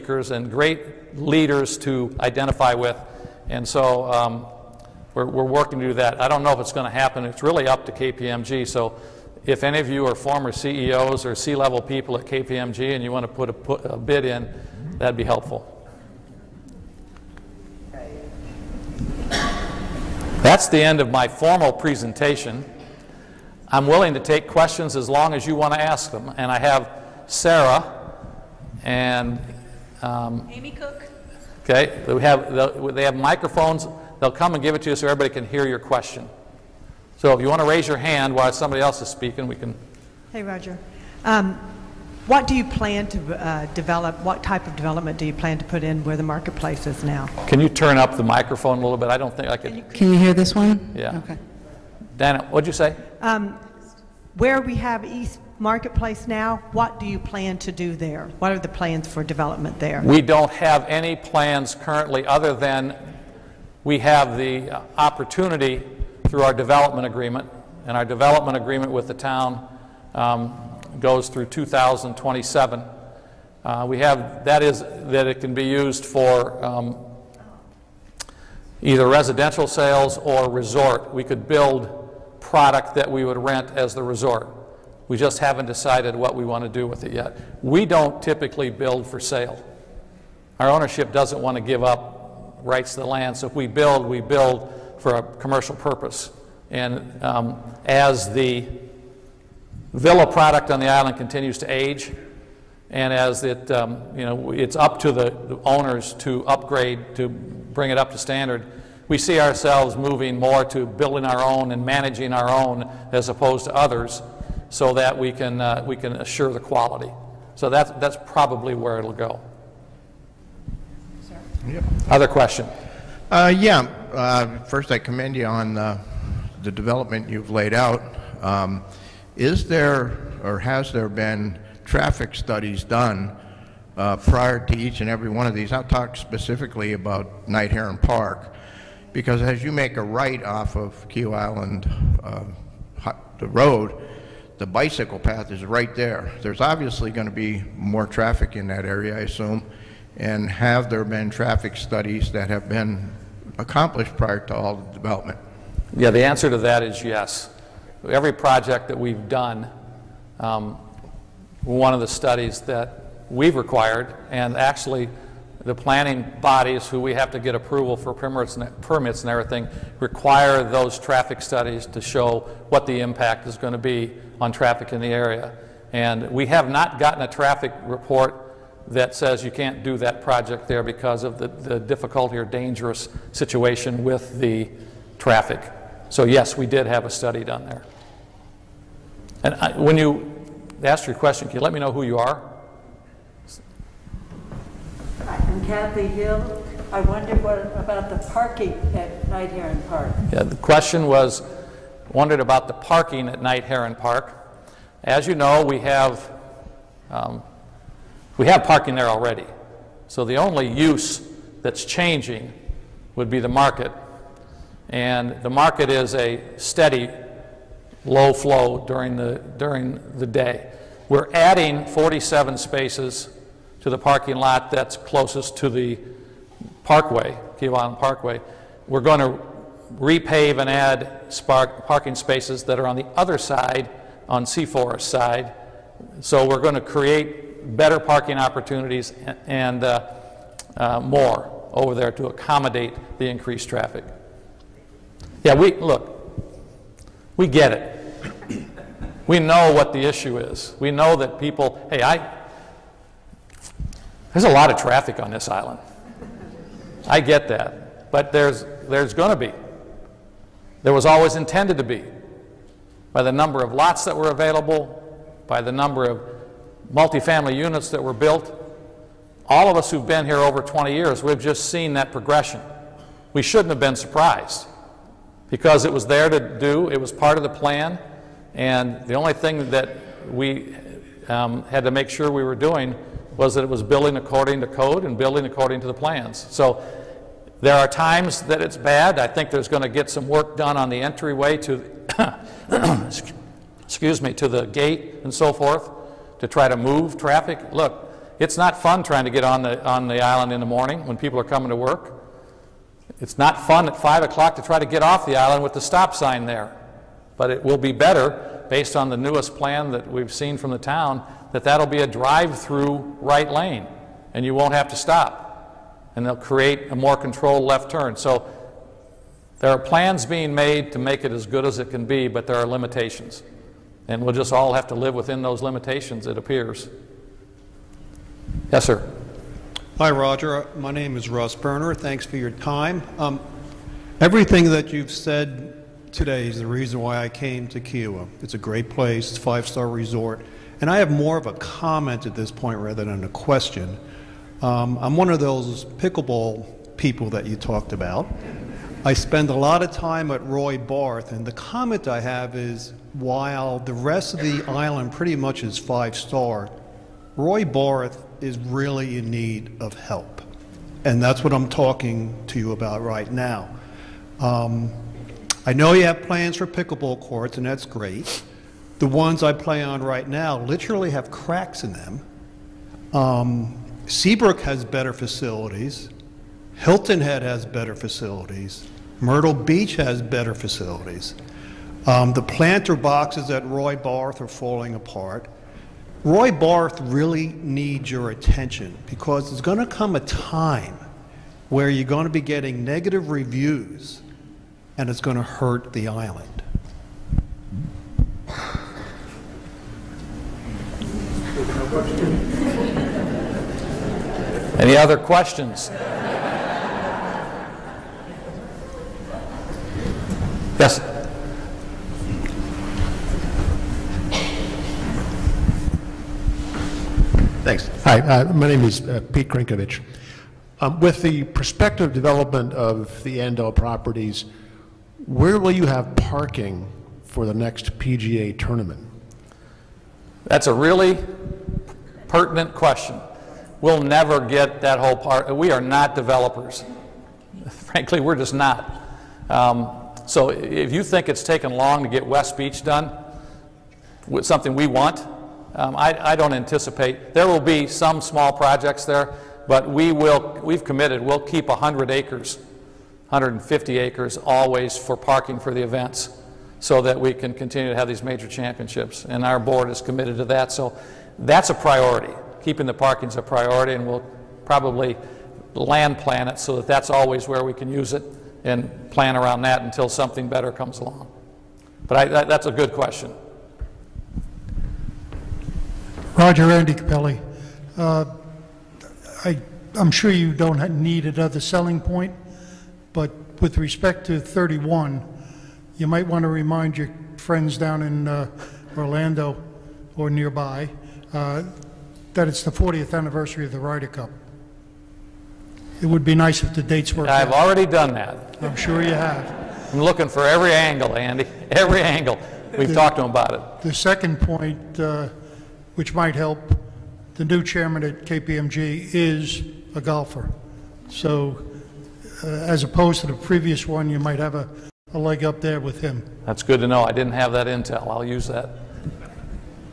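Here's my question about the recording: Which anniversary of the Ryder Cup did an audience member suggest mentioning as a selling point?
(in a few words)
40th.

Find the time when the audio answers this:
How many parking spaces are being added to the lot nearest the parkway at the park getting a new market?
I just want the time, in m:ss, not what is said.
3:41.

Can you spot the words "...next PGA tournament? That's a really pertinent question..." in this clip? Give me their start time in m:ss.
7:07.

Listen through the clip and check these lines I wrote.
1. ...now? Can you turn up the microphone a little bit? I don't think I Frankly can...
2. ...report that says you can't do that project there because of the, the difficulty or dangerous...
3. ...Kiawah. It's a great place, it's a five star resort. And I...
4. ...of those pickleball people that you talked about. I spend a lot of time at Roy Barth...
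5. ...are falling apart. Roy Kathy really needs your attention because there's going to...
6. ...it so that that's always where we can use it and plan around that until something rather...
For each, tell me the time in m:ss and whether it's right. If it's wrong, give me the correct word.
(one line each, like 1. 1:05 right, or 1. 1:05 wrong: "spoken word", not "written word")
1. 0:47 wrong: "Can", not "Frankly"
2. 2:57 right
3. 5:37 right
4. 5:45 right
5. 6:24 wrong: "Barth", not "Kathy"
6. 7:46 wrong: "better", not "rather".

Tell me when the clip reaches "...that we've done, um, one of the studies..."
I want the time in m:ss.
2:38.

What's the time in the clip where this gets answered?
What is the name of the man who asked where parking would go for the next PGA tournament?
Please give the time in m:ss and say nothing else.
6:59.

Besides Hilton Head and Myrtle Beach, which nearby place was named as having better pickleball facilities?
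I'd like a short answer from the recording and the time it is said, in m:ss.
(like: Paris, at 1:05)
Seabrook, at 6:14.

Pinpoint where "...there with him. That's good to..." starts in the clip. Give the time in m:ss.
8:35.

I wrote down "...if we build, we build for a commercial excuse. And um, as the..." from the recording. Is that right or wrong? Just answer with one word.
wrong.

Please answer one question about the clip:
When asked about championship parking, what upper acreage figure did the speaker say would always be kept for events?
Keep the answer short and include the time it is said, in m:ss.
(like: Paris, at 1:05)
150 acres, at 7:33.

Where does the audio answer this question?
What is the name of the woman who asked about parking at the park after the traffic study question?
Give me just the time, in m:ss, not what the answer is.
3:15.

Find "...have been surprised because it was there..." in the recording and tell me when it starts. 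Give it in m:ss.
4:33.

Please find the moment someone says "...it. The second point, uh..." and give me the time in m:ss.
8:23.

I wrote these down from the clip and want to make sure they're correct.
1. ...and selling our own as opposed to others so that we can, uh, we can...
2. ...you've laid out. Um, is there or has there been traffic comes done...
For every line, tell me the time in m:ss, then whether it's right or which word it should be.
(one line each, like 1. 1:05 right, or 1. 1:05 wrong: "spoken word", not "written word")
1. 1:51 wrong: "managing", not "selling"
2. 2:07 wrong: "studies", not "comes".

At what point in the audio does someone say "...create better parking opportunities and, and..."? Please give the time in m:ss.
3:56.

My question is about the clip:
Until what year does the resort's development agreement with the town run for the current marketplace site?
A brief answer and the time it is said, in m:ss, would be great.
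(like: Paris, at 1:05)
2027, at 1:11.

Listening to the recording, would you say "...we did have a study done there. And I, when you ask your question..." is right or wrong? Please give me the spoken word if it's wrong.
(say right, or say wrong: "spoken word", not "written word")
right.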